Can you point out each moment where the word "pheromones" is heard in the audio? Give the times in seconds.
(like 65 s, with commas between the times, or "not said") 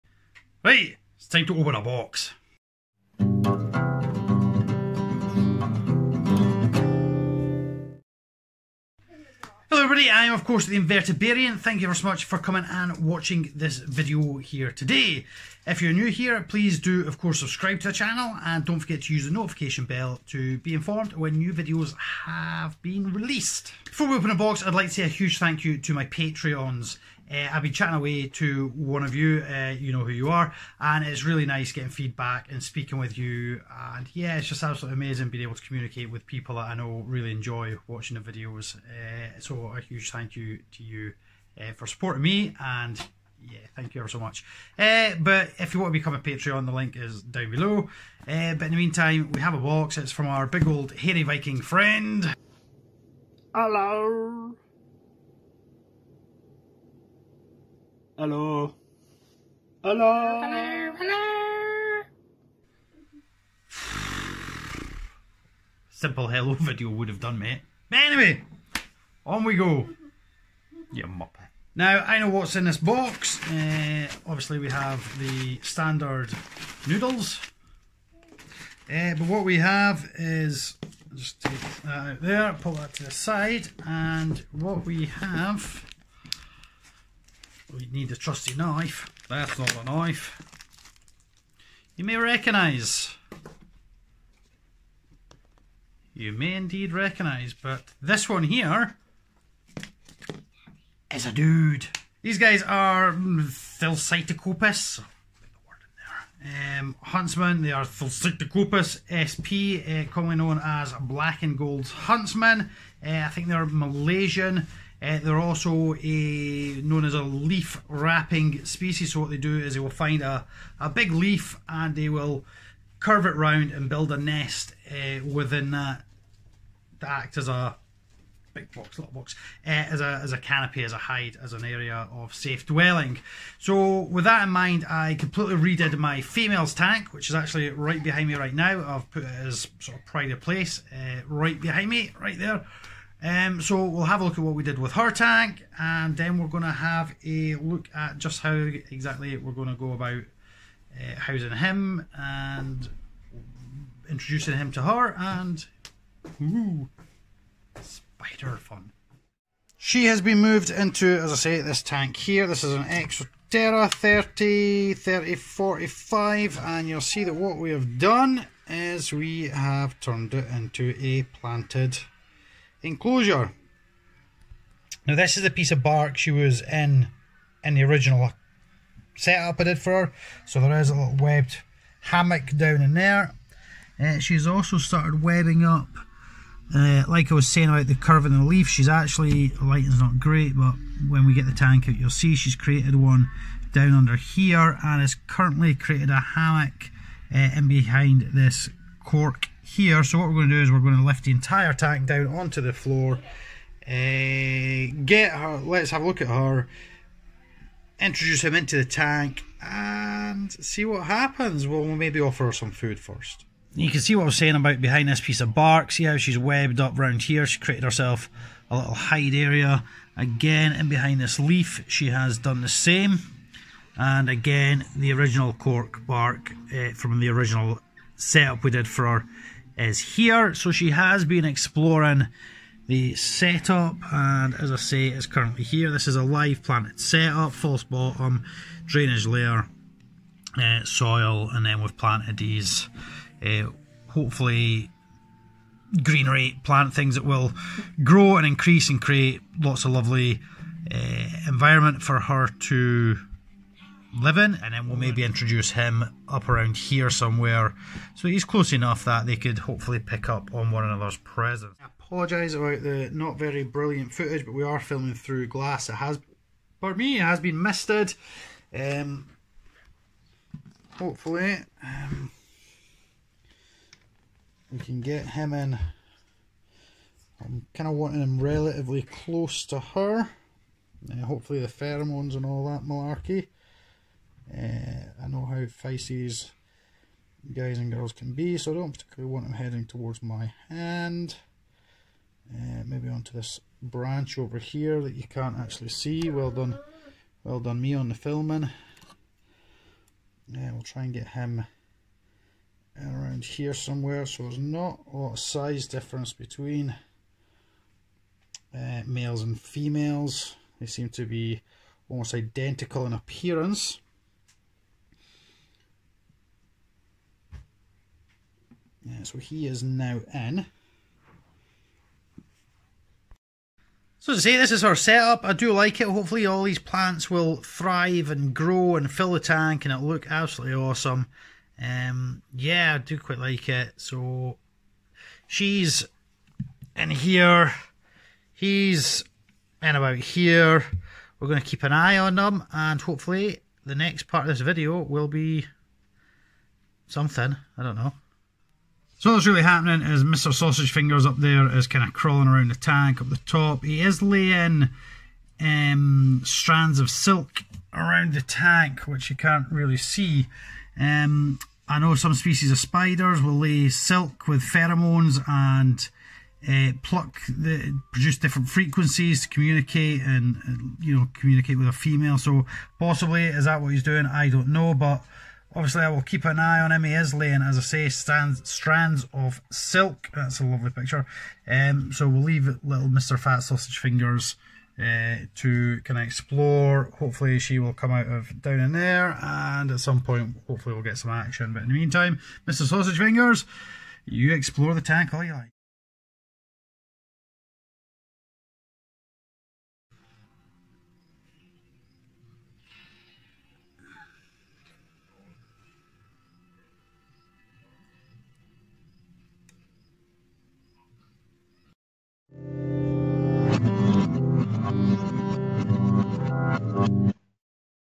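281 s, 364 s.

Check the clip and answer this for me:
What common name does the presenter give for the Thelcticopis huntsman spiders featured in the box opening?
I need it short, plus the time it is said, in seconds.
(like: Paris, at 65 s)
Black and Gold Huntsman, at 110 s.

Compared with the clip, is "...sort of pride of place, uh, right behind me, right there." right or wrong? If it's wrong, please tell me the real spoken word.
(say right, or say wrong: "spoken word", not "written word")
right.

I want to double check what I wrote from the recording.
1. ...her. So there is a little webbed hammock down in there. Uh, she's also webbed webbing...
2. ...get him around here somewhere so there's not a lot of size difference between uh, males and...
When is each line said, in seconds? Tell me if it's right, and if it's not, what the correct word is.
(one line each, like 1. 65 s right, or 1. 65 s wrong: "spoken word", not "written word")
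1. 180 s wrong: "started", not "webbed"
2. 301 s right.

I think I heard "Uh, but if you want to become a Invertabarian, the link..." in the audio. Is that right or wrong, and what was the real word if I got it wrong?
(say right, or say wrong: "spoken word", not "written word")
wrong: "Patreon", not "Invertabarian".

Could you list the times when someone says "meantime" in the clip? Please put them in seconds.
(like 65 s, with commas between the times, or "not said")
48 s, 391 s.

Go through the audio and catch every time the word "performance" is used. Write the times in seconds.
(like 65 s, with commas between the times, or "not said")
not said.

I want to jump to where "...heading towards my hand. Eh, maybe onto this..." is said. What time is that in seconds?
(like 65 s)
289 s.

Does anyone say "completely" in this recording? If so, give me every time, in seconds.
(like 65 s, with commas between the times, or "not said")
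135 s.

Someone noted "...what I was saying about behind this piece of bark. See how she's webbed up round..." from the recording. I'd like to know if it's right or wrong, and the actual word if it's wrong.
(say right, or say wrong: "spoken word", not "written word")
right.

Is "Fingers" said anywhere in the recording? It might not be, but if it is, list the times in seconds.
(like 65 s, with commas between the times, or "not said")
350 s, 383 s, 393 s.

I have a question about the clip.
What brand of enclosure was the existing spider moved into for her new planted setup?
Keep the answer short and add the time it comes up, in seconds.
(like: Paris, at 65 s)
Exoterra, at 162 s.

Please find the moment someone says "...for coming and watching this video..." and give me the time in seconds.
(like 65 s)
12 s.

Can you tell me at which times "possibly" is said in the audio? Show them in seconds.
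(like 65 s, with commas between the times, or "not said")
372 s.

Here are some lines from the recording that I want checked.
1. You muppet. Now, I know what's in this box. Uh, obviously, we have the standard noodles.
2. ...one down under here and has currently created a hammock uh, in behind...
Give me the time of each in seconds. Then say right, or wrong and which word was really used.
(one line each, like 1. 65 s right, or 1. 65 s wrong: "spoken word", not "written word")
1. 70 s right
2. 192 s right.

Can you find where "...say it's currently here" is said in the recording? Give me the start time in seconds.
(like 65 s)
234 s.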